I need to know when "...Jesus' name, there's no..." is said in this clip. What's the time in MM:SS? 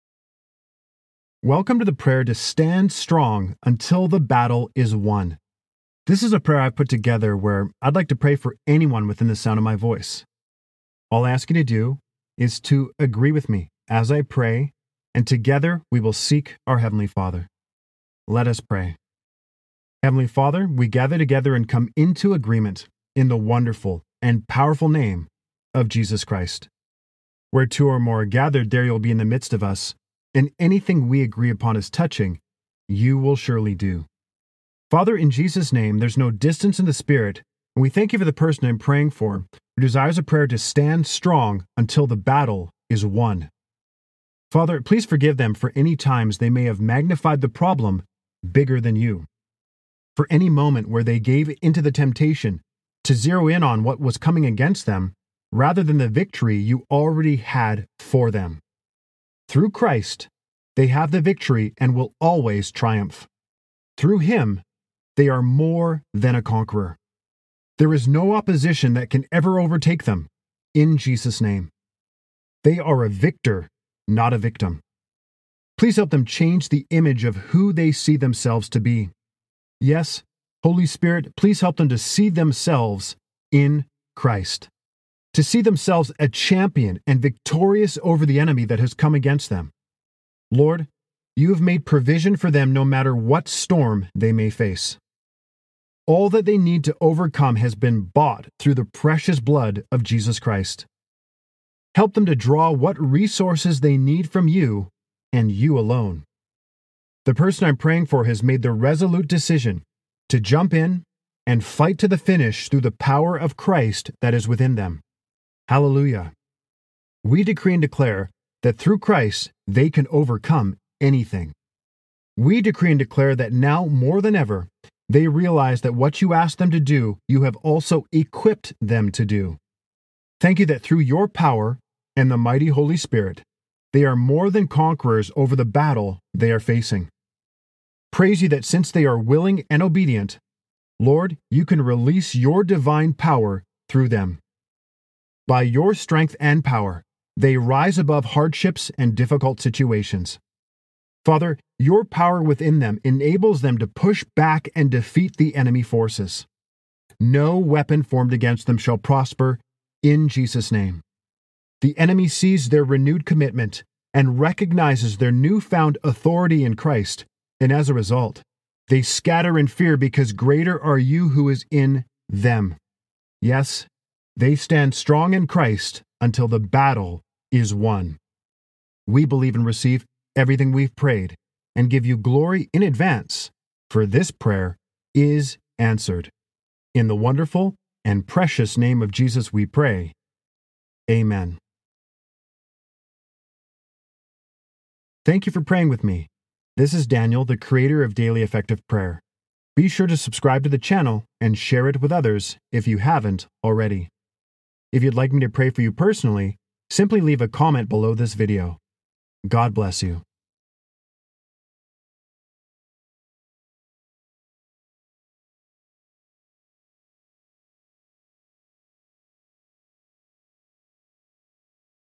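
00:35.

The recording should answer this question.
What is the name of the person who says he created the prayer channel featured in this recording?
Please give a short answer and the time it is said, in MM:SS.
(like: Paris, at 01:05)
Daniel, at 03:17.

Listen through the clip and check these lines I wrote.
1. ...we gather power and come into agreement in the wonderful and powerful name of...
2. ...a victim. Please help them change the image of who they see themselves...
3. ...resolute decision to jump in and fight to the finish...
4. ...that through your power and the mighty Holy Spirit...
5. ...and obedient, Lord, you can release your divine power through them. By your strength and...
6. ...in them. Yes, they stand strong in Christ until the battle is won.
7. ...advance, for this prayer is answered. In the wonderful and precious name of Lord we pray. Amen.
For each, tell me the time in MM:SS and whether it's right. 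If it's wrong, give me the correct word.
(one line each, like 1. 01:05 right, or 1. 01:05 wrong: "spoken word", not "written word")
1. 00:20 wrong: "together", not "power"
2. 01:14 right
3. 01:48 right
4. 02:10 right
5. 02:19 right
6. 02:51 right
7. 03:02 wrong: "Jesus", not "Lord".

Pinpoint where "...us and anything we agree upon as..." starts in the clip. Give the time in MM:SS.
00:29.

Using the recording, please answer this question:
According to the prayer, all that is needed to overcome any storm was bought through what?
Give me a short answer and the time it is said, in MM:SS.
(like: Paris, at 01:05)
The precious blood of Jesus Christ, at 01:38.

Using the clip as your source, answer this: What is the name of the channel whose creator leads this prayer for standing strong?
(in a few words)
Daily Effective Prayer.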